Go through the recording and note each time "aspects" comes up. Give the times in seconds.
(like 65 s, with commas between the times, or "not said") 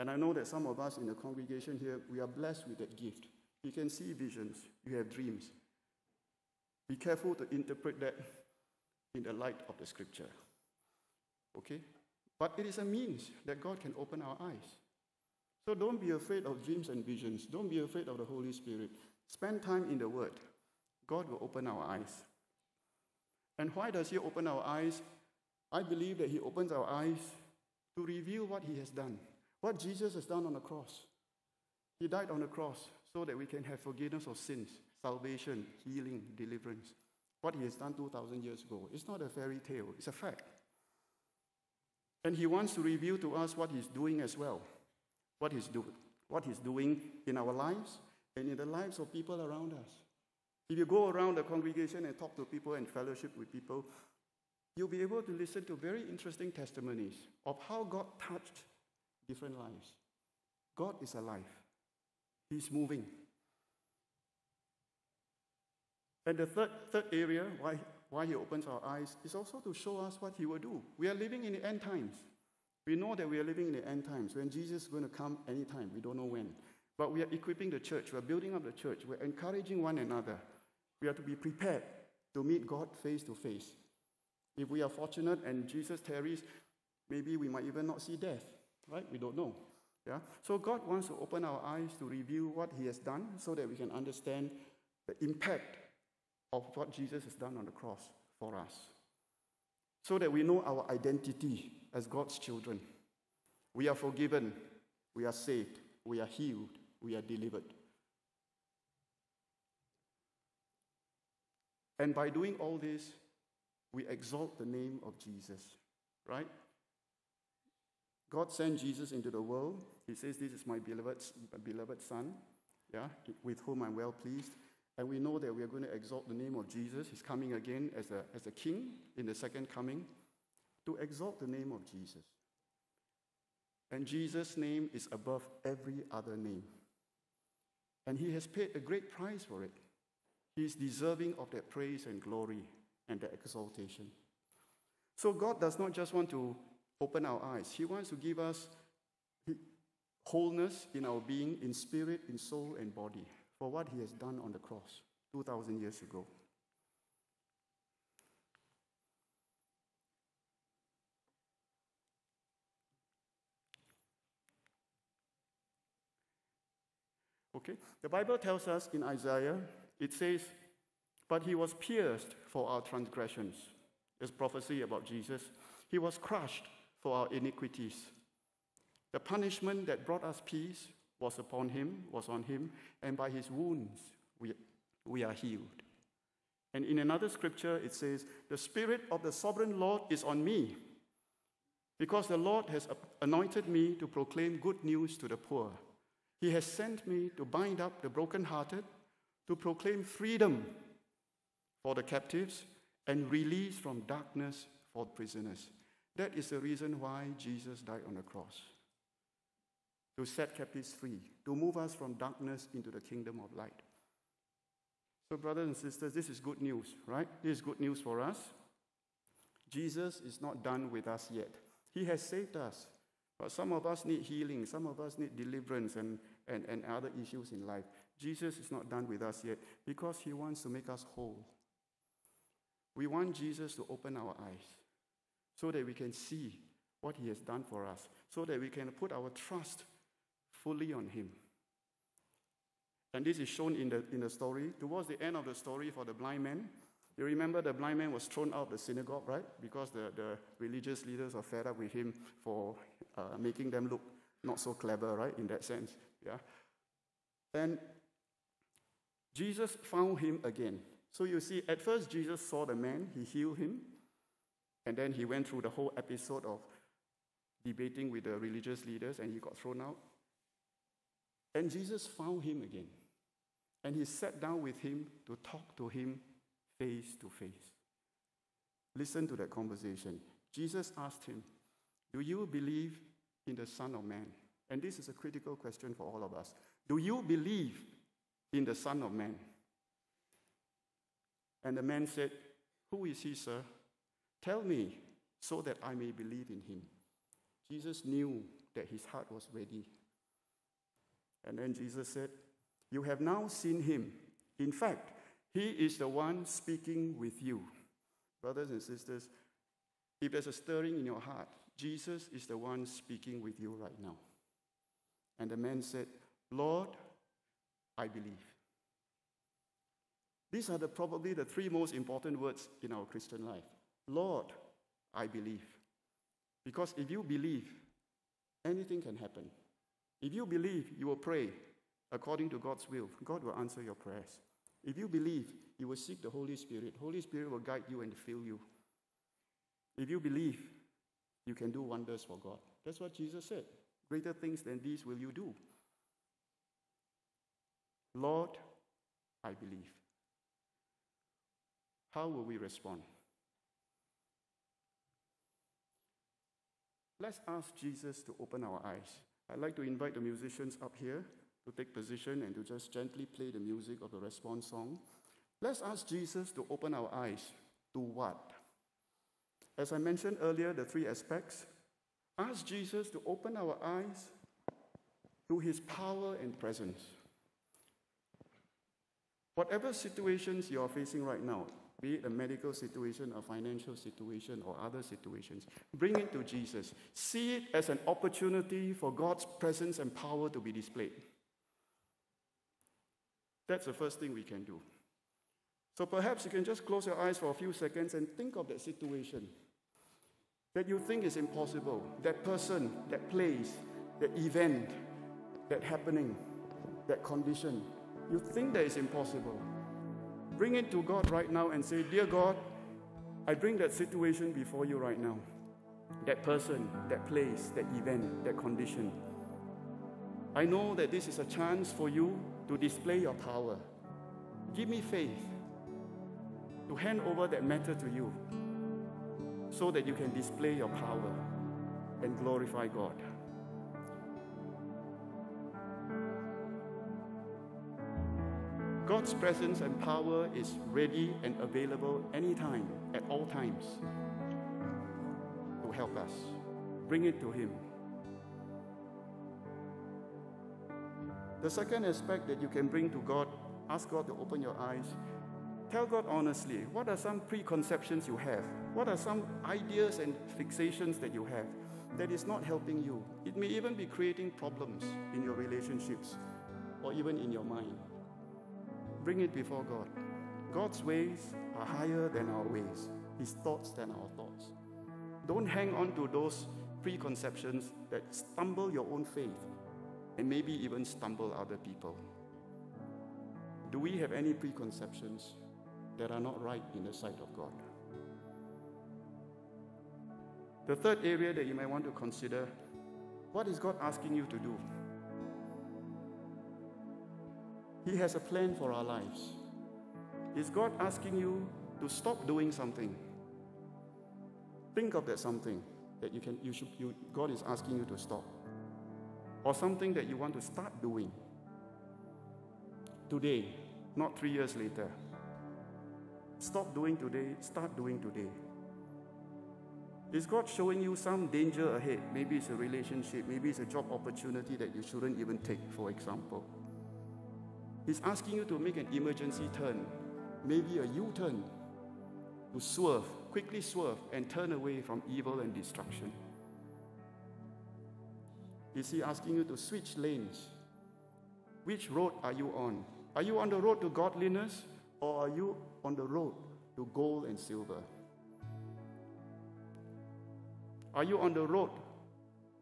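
371 s, 452 s.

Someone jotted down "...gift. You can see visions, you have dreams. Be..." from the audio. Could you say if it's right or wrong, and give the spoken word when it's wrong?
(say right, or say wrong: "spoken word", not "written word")
right.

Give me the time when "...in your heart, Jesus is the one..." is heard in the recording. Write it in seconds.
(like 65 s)
310 s.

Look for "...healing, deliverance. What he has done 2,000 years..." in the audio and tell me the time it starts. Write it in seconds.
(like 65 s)
35 s.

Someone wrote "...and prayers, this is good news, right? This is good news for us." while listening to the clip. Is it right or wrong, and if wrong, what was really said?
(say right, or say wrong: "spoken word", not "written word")
wrong: "sisters", not "prayers".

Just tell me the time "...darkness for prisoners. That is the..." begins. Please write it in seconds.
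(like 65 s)
204 s.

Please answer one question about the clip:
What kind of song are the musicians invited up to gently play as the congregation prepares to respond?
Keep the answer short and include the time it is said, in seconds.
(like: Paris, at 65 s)
the response song, at 364 s.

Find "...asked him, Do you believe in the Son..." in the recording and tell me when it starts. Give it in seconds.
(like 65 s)
280 s.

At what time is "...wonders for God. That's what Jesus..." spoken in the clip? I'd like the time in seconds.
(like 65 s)
341 s.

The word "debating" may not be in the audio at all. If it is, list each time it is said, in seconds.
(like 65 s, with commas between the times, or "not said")
267 s.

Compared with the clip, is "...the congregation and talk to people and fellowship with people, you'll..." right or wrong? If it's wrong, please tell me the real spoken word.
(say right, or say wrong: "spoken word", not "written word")
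right.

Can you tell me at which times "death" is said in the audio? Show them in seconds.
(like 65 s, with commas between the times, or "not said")
88 s.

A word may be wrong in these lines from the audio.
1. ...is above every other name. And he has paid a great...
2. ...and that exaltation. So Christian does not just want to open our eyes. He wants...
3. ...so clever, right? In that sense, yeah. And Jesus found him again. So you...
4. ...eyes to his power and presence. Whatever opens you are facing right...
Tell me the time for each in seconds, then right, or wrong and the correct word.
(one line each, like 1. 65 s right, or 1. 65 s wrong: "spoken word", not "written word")
1. 134 s right
2. 143 s wrong: "God", not "Christian"
3. 254 s right
4. 373 s wrong: "situations", not "opens".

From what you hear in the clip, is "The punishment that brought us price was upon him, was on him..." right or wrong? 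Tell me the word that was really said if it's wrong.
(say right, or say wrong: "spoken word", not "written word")
wrong: "peace", not "price".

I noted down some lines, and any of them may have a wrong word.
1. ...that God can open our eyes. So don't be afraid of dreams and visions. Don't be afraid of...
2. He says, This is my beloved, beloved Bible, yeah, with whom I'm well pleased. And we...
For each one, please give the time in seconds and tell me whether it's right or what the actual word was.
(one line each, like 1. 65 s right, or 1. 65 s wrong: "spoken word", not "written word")
1. 13 s right
2. 120 s wrong: "Son", not "Bible".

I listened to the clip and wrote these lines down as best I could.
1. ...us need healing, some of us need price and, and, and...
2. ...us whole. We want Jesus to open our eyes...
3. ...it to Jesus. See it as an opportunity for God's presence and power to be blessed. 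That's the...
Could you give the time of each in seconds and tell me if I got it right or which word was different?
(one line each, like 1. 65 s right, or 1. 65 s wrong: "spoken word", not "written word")
1. 223 s wrong: "deliverance", not "price"
2. 230 s right
3. 386 s wrong: "displayed", not "blessed".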